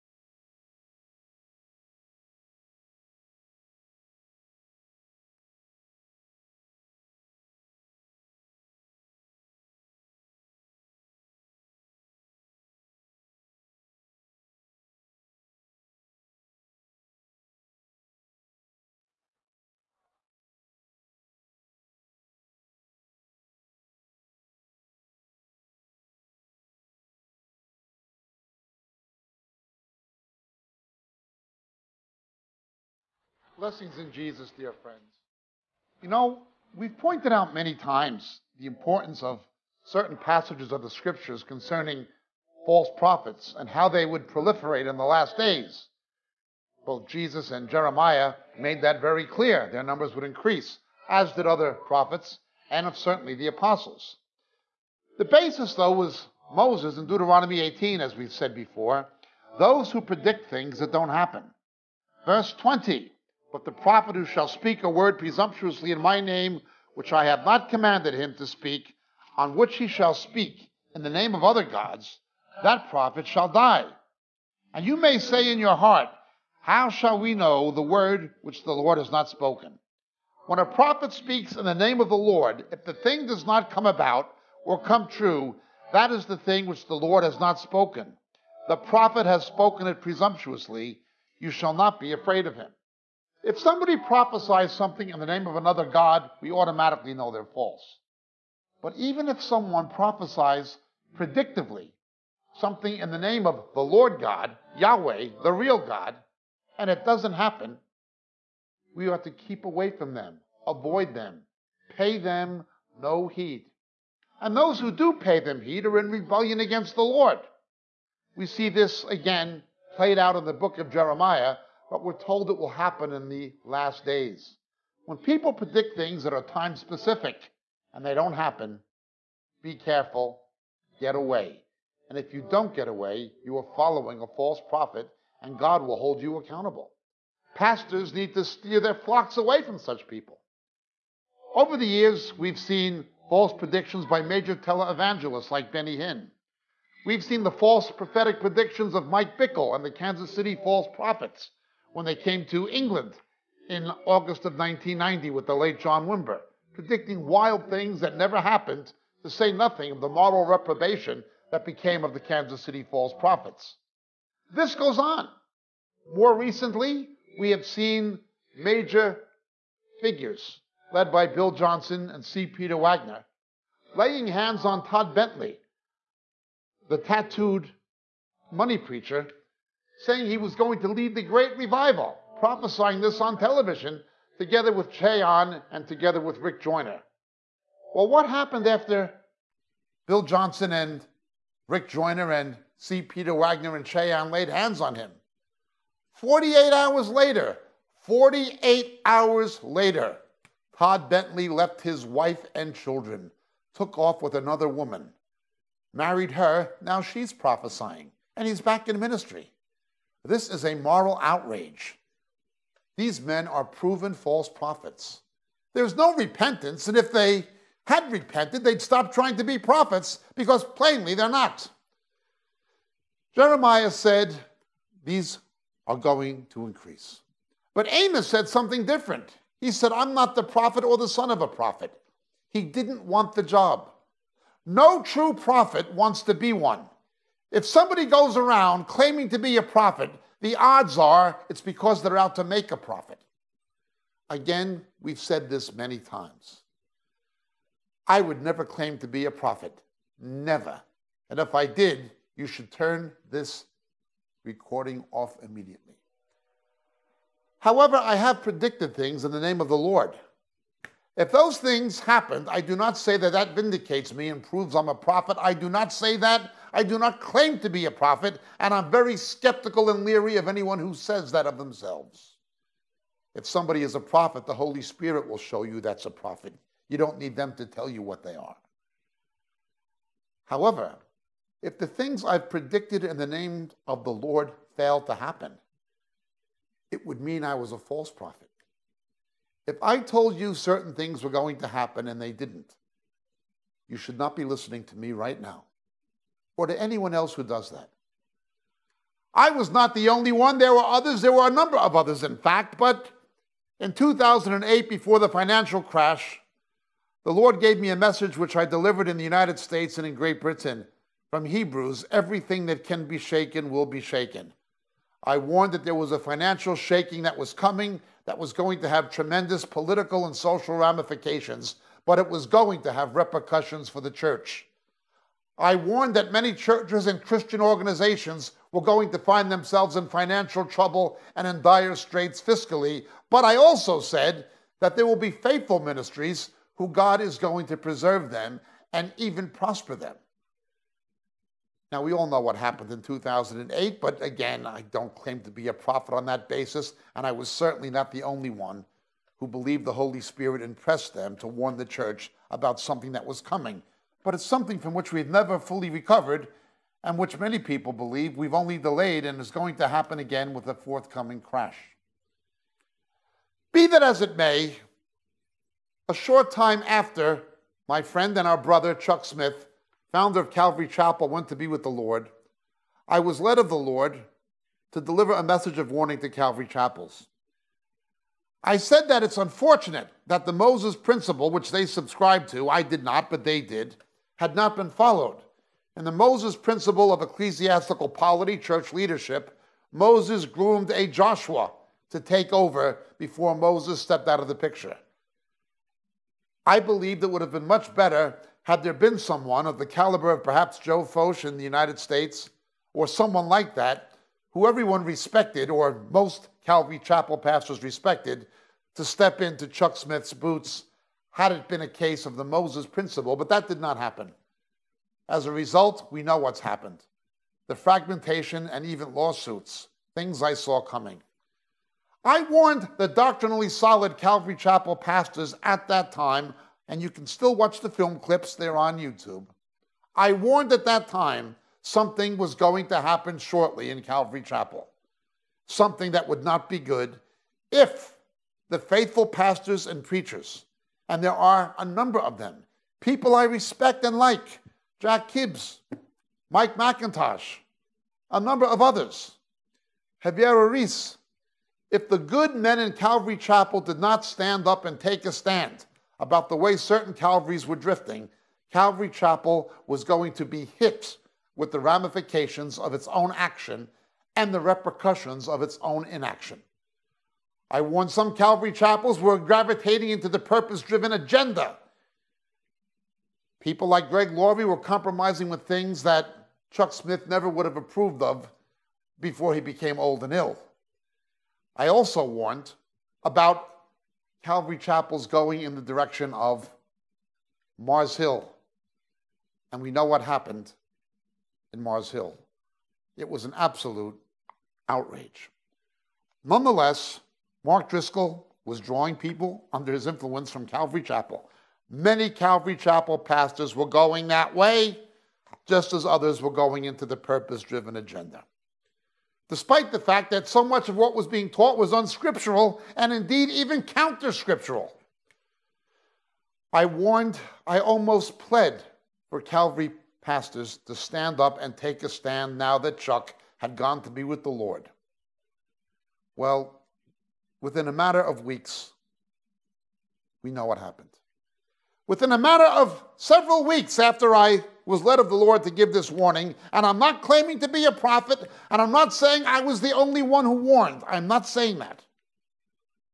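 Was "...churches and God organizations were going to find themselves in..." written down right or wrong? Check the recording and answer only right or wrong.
wrong.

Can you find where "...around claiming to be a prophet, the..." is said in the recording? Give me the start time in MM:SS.
03:58.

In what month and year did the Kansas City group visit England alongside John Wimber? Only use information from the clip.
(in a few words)
August 1990.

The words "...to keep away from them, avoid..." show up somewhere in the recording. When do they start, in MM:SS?
01:49.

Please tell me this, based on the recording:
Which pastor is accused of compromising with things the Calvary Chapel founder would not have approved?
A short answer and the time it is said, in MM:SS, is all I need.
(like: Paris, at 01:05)
Greg Laurie, at 07:54.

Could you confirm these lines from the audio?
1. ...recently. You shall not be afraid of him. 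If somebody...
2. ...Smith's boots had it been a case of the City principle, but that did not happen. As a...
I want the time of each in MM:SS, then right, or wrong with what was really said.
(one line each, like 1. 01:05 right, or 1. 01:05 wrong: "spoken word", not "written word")
1. 01:30 wrong: "presumptuously", not "recently"
2. 06:49 wrong: "Moses", not "City".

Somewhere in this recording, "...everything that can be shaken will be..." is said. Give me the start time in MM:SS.
05:12.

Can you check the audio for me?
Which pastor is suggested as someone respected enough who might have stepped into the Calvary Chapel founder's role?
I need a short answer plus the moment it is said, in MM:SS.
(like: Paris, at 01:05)
Joe Focht, at 06:40.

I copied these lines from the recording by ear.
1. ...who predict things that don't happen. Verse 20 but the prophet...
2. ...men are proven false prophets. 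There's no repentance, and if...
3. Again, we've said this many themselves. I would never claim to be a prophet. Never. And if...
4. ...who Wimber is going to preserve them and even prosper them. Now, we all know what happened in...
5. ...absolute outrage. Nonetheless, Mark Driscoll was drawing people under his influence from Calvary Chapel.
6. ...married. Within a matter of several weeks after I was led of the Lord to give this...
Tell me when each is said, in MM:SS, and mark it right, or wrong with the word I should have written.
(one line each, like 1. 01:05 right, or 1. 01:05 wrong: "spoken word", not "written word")
1. 00:59 right
2. 03:33 right
3. 04:04 wrong: "times", not "themselves"
4. 05:36 wrong: "God", not "Wimber"
5. 08:13 right
6. 08:50 wrong: "happened", not "married".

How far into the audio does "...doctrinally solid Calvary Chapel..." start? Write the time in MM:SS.
07:03.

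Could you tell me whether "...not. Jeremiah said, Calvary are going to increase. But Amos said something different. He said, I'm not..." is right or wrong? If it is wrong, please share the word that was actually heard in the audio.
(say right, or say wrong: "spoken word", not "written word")
wrong: "These", not "Calvary".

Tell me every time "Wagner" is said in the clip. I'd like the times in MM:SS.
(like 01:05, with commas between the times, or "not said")
02:52, 03:13.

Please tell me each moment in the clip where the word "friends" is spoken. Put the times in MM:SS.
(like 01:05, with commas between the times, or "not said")
00:34, 06:08.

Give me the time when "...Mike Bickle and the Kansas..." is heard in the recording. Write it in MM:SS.
02:29.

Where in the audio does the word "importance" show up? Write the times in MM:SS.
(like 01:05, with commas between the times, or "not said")
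00:38.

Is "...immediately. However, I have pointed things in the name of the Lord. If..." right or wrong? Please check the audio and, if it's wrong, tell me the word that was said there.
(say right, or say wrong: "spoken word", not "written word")
wrong: "predicted", not "pointed".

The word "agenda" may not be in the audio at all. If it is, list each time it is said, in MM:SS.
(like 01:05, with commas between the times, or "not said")
07:51, 08:27.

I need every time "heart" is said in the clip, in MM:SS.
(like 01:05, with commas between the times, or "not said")
01:15.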